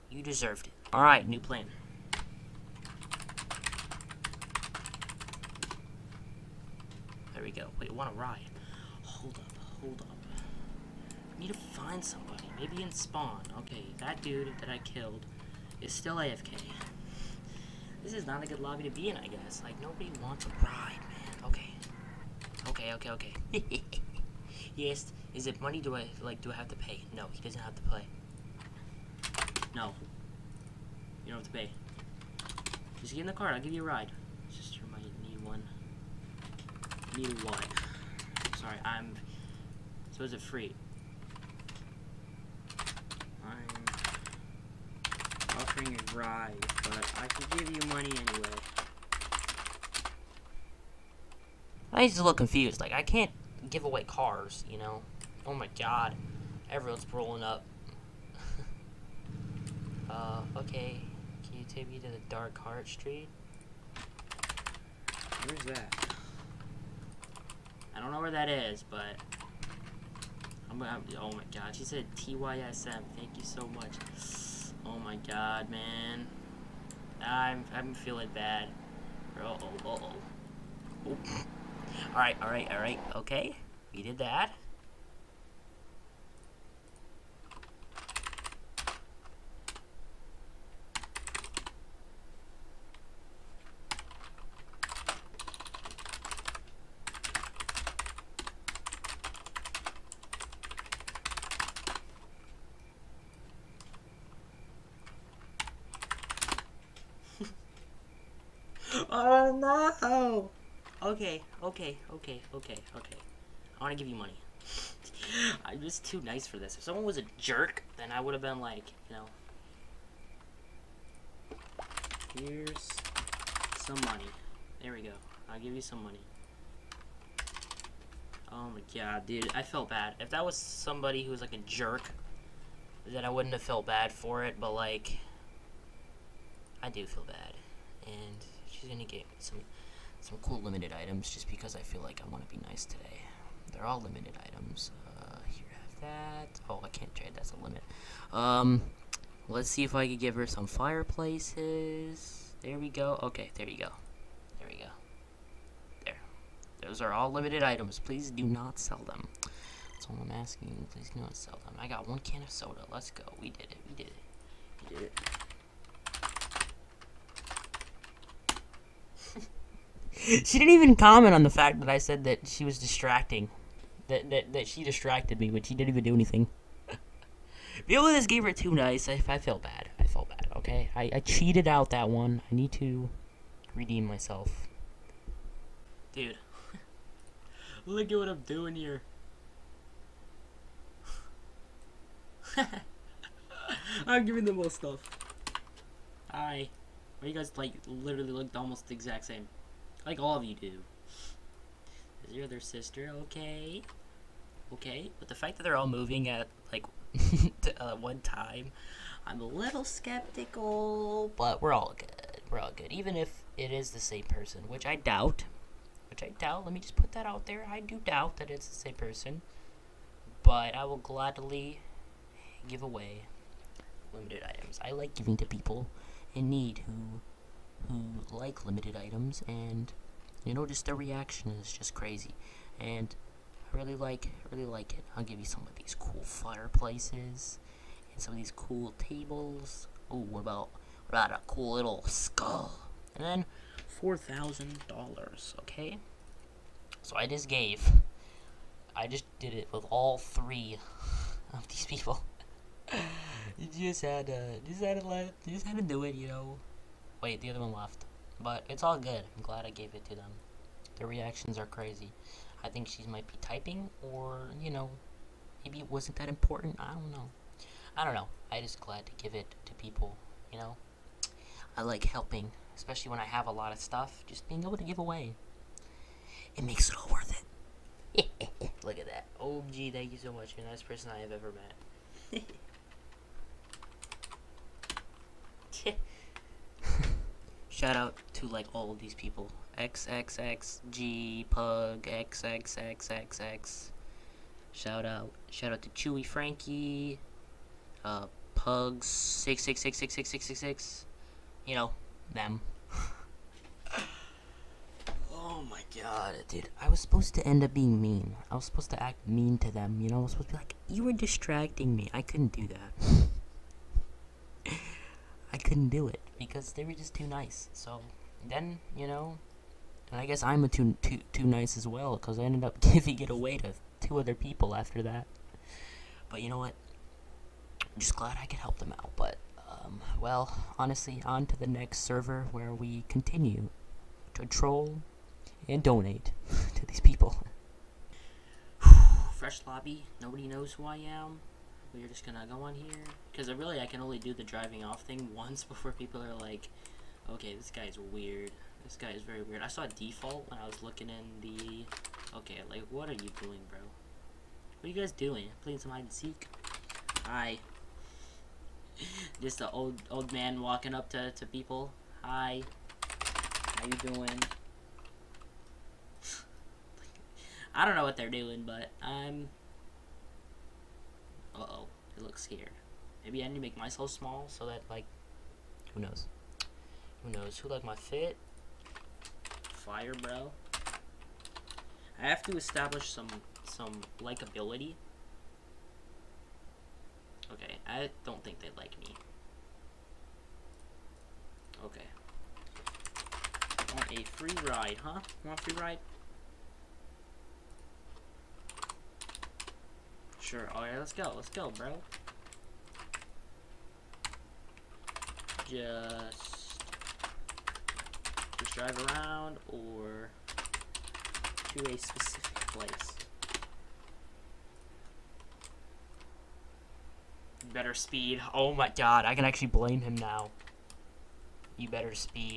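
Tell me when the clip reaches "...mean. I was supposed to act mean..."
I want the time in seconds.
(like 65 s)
307 s.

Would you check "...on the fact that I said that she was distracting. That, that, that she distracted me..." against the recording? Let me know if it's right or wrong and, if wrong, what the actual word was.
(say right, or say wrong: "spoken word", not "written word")
right.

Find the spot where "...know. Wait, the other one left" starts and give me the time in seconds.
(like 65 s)
256 s.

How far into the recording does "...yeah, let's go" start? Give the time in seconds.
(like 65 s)
400 s.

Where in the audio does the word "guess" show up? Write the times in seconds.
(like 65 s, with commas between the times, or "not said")
19 s, 320 s.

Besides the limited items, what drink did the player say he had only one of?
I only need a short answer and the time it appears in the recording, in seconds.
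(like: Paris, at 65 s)
soda, at 162 s.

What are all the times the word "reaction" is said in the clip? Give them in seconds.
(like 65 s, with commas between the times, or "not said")
230 s, 261 s.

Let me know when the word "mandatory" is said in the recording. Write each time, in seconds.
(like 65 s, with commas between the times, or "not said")
not said.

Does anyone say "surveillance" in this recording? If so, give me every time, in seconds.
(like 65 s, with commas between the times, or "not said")
not said.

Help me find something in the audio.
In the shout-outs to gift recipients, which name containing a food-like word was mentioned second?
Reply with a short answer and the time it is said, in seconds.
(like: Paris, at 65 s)
Chewy Frankie, at 295 s.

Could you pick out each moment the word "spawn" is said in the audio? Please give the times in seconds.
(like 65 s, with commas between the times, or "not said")
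12 s.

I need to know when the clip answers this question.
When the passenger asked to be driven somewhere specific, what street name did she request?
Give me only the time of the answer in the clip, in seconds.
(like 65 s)
62 s.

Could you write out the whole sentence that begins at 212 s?
Even if it is the same person, which I doubt.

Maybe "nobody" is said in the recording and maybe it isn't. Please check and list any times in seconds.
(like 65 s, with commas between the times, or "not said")
19 s, 340 s.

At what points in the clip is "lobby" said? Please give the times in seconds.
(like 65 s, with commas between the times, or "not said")
18 s, 339 s.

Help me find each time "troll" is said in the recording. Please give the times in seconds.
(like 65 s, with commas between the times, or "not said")
334 s.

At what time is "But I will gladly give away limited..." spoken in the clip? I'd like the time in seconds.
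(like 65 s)
220 s.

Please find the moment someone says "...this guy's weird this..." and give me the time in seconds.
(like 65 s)
347 s.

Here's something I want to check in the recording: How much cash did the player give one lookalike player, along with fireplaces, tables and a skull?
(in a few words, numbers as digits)
$4,000.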